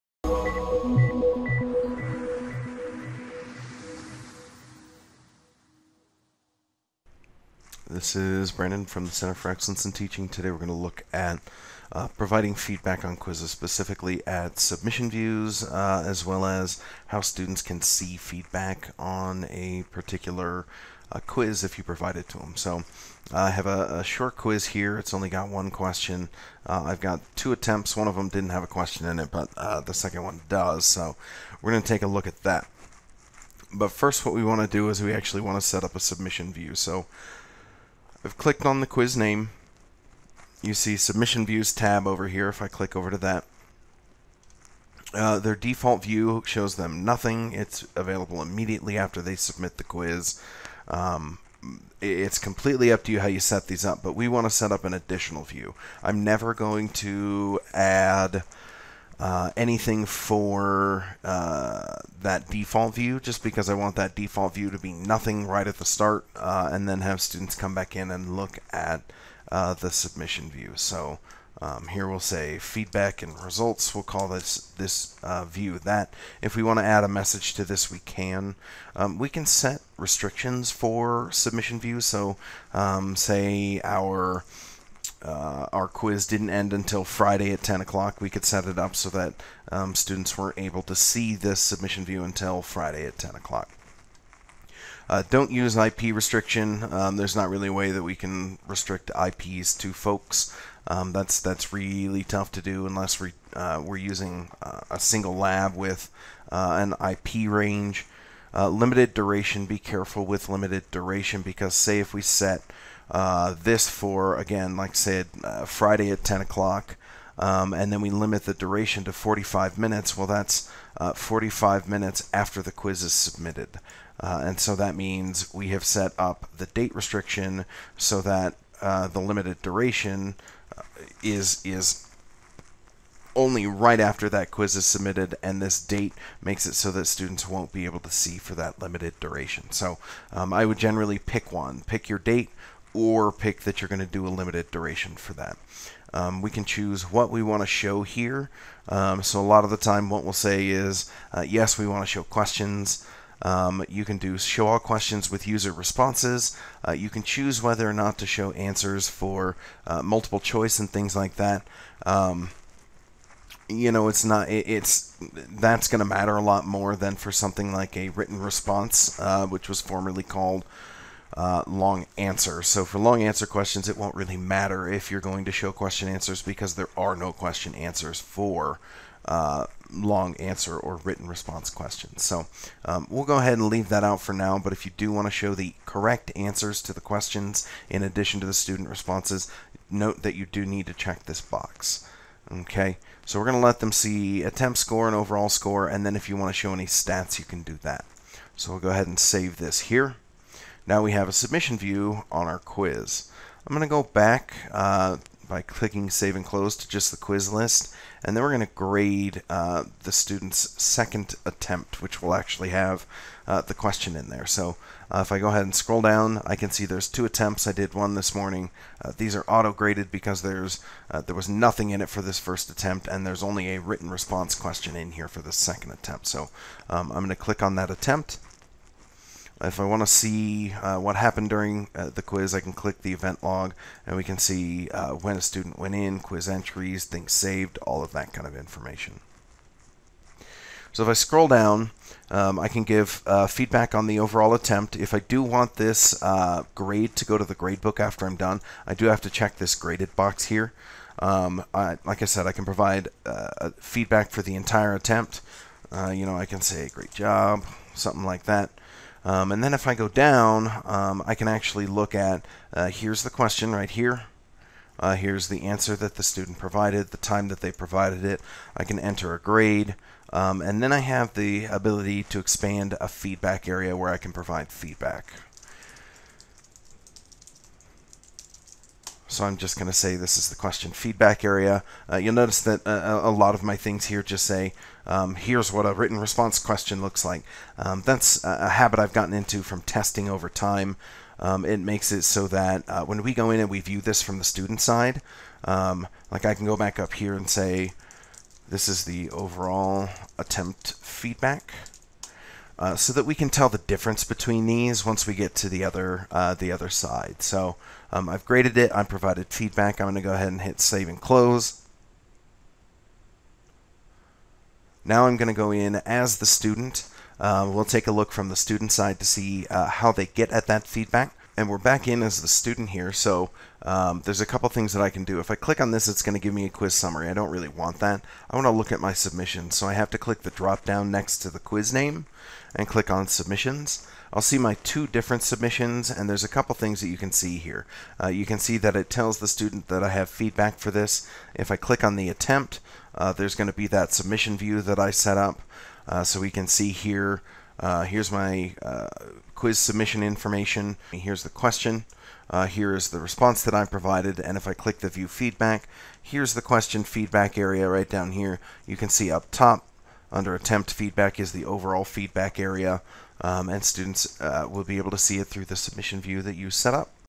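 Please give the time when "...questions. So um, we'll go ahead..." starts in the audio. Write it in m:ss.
3:01.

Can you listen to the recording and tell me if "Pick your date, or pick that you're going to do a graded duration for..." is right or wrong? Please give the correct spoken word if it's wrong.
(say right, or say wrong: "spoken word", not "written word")
wrong: "limited", not "graded".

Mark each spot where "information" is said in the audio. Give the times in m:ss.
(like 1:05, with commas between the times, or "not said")
3:58, 5:50.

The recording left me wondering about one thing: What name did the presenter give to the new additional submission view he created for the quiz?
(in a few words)
Feedback and results.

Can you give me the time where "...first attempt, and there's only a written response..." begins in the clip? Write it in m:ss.
3:42.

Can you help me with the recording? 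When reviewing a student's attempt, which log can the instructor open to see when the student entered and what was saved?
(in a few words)
Event log.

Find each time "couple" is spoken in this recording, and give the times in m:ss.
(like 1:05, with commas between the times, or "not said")
5:24, 5:36.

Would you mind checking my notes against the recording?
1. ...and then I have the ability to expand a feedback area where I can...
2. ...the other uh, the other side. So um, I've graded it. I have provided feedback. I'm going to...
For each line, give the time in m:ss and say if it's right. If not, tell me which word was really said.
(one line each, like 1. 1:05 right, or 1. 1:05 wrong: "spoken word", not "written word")
1. 4:30 right
2. 5:05 right.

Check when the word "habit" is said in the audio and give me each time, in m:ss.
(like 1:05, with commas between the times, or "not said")
4:48.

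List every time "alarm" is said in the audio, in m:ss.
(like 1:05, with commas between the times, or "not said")
not said.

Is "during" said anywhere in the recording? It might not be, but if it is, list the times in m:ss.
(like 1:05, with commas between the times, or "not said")
3:51.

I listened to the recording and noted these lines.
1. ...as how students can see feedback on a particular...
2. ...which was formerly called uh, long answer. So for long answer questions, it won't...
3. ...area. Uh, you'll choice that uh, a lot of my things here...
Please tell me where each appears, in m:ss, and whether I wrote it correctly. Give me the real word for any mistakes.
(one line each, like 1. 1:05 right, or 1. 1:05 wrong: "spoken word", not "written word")
1. 0:16 right
2. 2:49 right
3. 4:41 wrong: "notice", not "choice".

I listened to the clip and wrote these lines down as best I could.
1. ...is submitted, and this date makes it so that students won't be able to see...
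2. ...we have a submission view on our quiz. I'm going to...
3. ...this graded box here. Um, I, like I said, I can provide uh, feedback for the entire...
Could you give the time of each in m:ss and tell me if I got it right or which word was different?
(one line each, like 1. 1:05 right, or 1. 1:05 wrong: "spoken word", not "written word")
1. 2:14 right
2. 3:21 right
3. 4:09 right.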